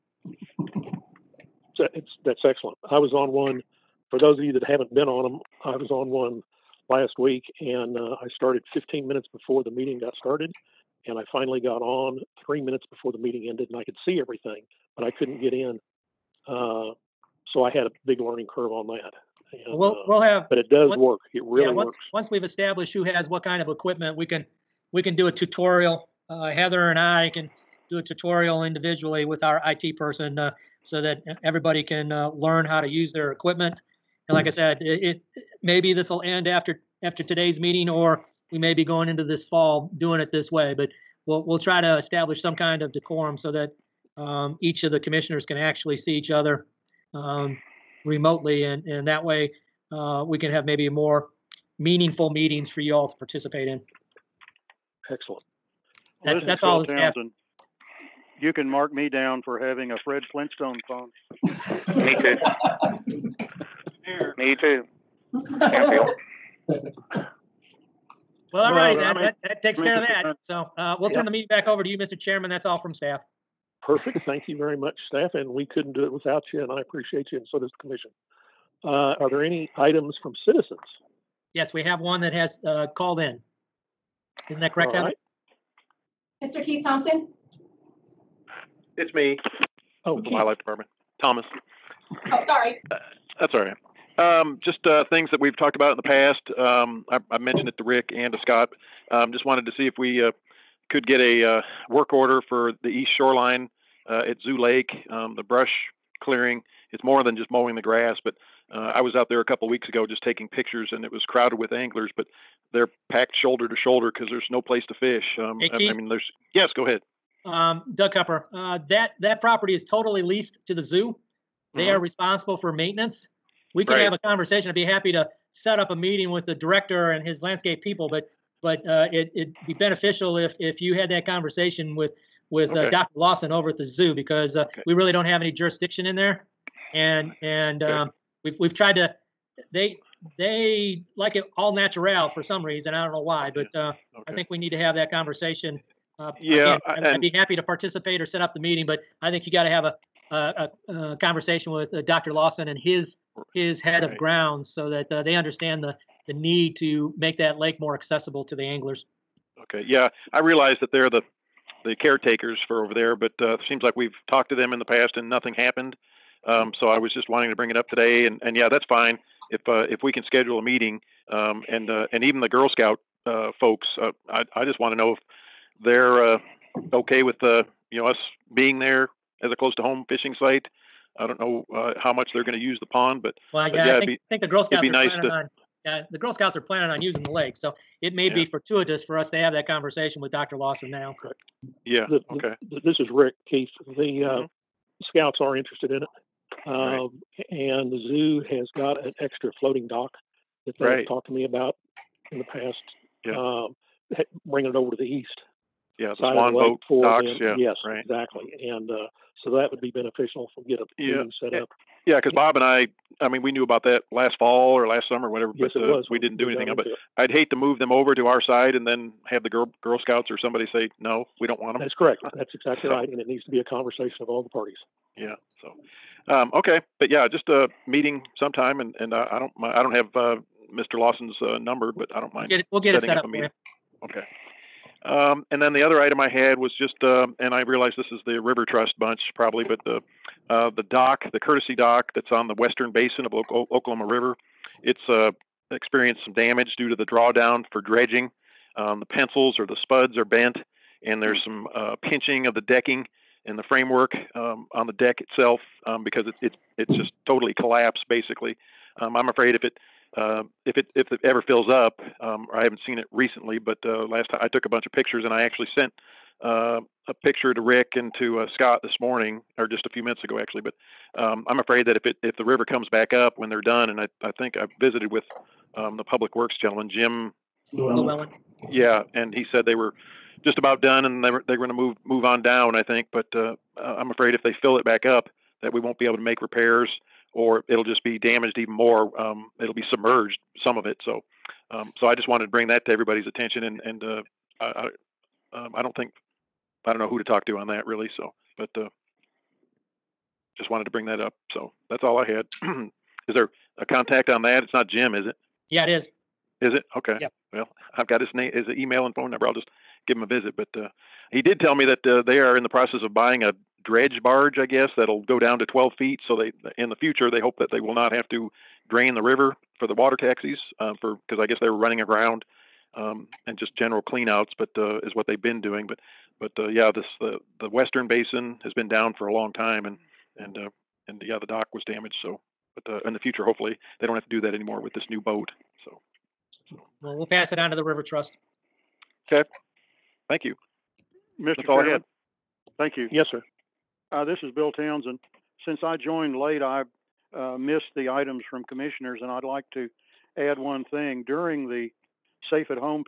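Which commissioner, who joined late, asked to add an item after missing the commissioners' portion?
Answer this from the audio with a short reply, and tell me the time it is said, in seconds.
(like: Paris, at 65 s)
Bill Townsend, at 344 s.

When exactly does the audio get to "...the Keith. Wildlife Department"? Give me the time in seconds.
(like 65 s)
90 s.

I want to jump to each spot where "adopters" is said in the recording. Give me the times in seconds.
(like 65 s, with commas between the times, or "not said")
not said.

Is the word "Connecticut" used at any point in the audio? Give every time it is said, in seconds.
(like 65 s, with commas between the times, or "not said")
not said.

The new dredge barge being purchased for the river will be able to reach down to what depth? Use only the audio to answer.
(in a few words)
12 feet.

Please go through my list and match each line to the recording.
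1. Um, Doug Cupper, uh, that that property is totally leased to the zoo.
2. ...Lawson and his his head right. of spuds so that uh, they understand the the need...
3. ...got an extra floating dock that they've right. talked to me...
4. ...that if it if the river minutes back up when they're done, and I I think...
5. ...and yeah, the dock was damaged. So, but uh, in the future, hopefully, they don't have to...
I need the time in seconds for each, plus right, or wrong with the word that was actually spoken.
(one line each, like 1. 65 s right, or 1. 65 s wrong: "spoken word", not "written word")
1. 117 s right
2. 152 s wrong: "grounds", not "spuds"
3. 198 s right
4. 271 s wrong: "comes", not "minutes"
5. 331 s right.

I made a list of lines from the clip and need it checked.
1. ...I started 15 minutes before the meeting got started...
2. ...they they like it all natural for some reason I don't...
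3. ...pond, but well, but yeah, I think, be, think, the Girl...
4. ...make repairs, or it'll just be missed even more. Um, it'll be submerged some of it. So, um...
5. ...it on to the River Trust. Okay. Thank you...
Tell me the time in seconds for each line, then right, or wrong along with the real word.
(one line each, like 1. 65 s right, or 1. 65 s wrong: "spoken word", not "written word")
1. 8 s right
2. 139 s right
3. 182 s right
4. 286 s wrong: "damaged", not "missed"
5. 337 s right.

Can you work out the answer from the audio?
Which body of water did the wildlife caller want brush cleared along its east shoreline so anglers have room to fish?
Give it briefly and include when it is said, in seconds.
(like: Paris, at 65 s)
Zoo Lake, at 104 s.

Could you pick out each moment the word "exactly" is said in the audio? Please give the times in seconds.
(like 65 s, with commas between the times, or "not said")
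208 s, 222 s.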